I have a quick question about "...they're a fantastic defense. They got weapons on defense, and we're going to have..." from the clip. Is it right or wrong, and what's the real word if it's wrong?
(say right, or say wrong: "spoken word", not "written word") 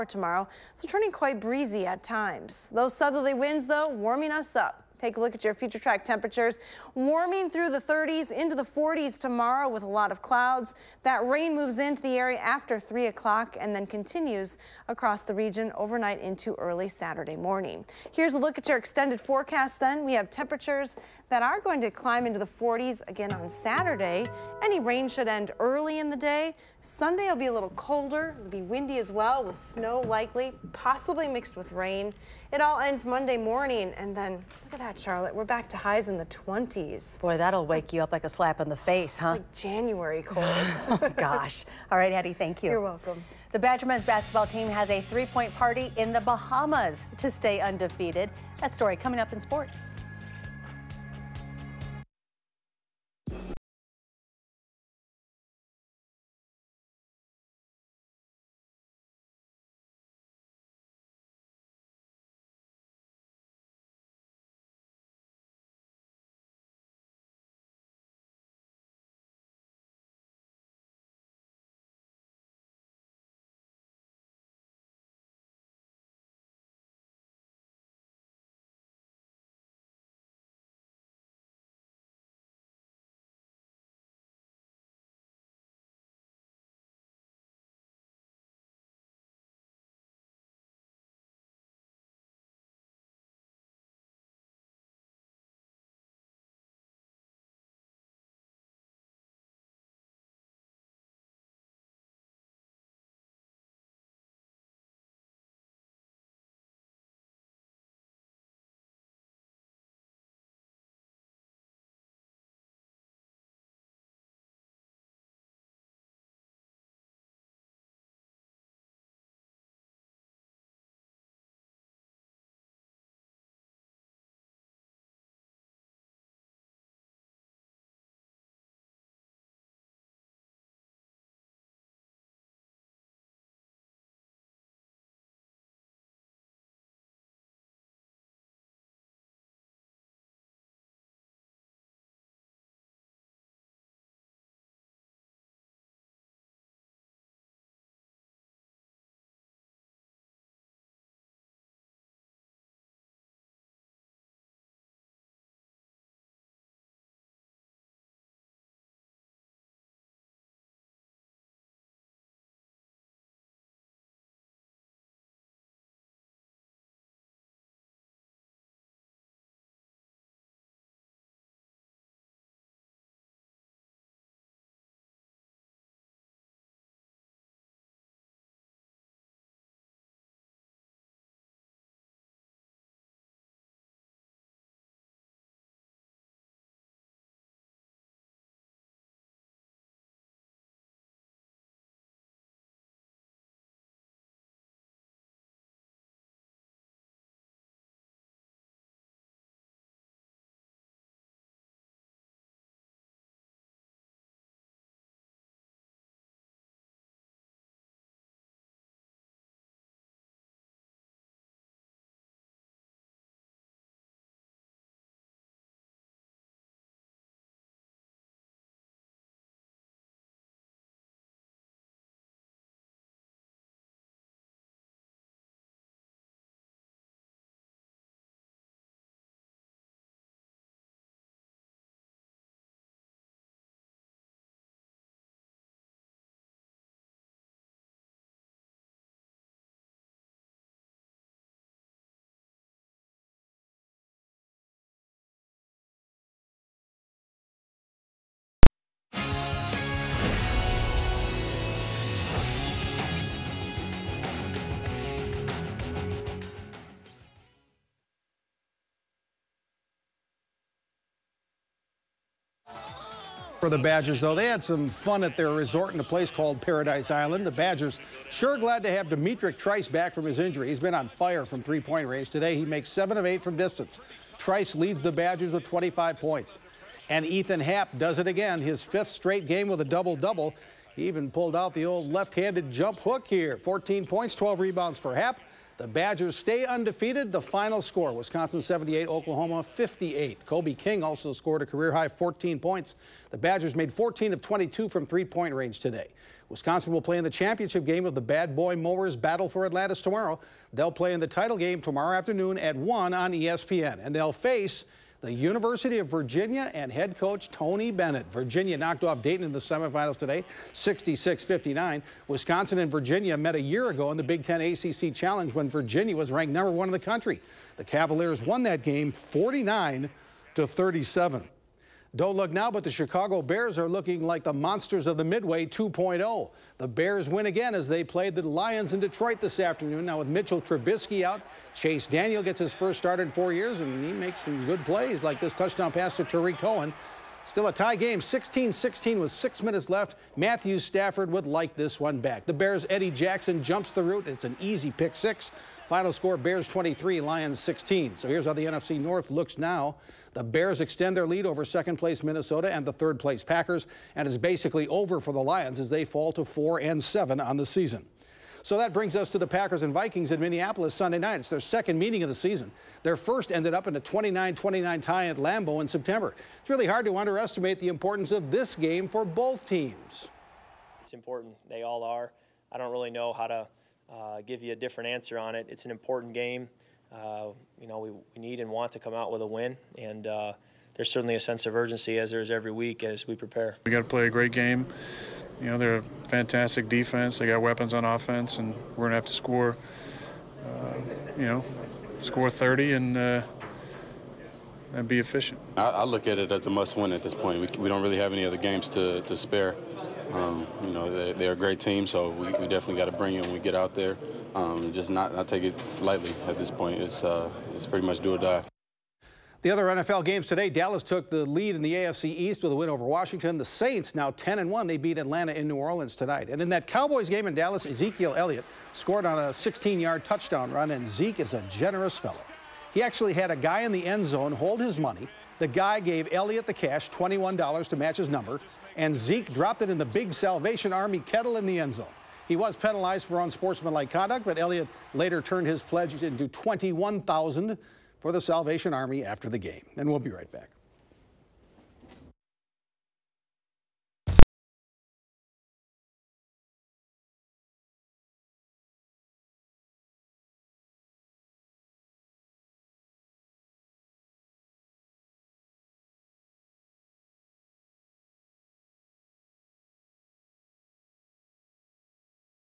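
wrong: "offense", not "defense".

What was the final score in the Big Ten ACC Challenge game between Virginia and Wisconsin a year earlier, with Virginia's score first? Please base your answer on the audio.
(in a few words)
49-37.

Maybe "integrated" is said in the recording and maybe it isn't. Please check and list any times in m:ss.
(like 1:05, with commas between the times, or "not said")
not said.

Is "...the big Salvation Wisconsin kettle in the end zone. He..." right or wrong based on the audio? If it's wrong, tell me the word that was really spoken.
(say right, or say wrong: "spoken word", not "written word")
wrong: "Army", not "Wisconsin".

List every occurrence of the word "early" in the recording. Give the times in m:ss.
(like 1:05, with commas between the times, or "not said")
0:16, 0:25.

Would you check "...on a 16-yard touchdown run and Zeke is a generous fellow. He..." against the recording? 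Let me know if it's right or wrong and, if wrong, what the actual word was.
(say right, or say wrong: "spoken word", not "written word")
right.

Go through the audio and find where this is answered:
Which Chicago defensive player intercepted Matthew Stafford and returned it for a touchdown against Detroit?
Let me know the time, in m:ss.
5:42.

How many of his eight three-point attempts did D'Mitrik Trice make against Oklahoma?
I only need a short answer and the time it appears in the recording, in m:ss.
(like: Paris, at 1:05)
7, at 4:32.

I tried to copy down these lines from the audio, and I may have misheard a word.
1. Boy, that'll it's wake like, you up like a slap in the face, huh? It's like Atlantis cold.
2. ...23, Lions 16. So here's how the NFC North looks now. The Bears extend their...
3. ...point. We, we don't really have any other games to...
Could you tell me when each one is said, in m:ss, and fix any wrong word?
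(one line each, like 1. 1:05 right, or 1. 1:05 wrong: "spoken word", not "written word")
1. 0:37 wrong: "January", not "Atlantis"
2. 5:46 right
3. 6:37 right.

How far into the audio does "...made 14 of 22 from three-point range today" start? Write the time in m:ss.
4:53.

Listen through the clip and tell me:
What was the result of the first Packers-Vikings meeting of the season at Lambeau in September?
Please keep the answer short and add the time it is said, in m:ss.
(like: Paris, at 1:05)
29-29 tie, at 6:04.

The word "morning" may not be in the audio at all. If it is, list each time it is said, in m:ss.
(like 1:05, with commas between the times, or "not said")
0:17, 0:33.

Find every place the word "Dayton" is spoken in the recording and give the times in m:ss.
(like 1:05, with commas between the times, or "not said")
5:09.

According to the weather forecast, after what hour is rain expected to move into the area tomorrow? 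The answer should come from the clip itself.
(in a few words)
3 o'clock.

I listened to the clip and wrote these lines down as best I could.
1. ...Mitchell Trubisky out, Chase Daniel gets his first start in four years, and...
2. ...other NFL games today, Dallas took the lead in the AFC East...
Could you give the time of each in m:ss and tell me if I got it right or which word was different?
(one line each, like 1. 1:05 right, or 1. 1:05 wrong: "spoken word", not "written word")
1. 5:30 right
2. 6:49 right.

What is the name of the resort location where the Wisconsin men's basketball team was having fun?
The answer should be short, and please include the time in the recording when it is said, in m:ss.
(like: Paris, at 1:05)
Paradise Island, at 4:26.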